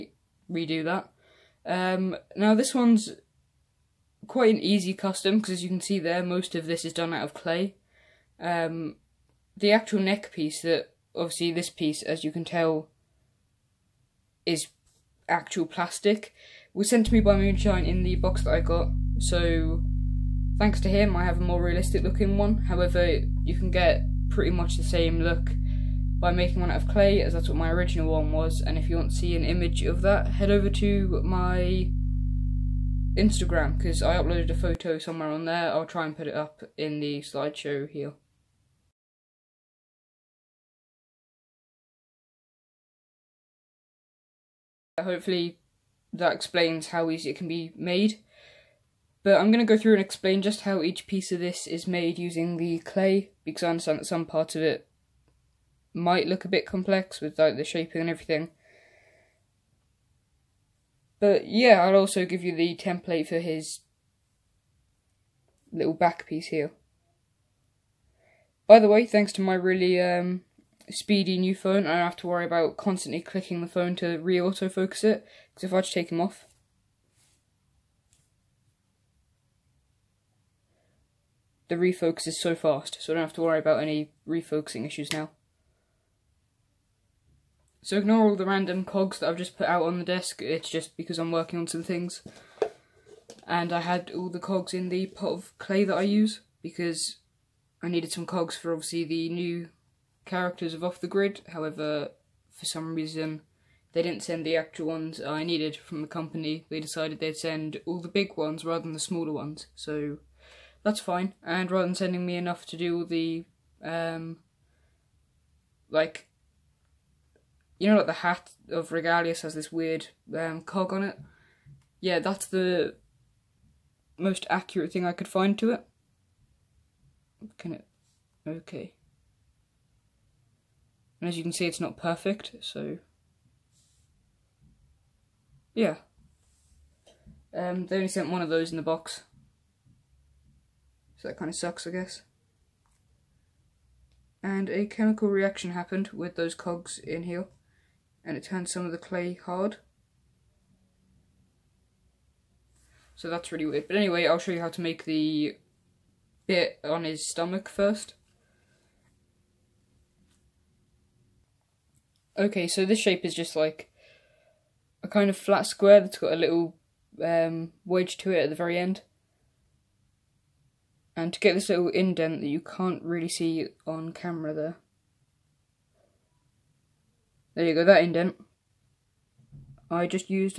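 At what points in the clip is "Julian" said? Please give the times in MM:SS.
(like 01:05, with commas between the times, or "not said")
not said.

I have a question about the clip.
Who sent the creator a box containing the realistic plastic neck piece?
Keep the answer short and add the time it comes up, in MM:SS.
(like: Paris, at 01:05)
Moonshine, at 00:17.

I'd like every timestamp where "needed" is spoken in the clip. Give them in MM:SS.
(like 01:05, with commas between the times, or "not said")
01:37, 01:45.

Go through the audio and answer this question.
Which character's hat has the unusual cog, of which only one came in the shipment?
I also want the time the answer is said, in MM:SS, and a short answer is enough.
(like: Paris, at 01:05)
Regalius, at 01:58.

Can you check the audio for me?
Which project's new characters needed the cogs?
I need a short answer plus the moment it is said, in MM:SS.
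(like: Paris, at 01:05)
Off the Grid, at 01:40.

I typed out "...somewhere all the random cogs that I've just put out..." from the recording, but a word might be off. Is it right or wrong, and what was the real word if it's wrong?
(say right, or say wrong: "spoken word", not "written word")
wrong: "ignore", not "somewhere".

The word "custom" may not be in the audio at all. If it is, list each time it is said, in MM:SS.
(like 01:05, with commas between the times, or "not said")
00:04.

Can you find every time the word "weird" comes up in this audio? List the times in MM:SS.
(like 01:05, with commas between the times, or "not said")
01:59, 02:33.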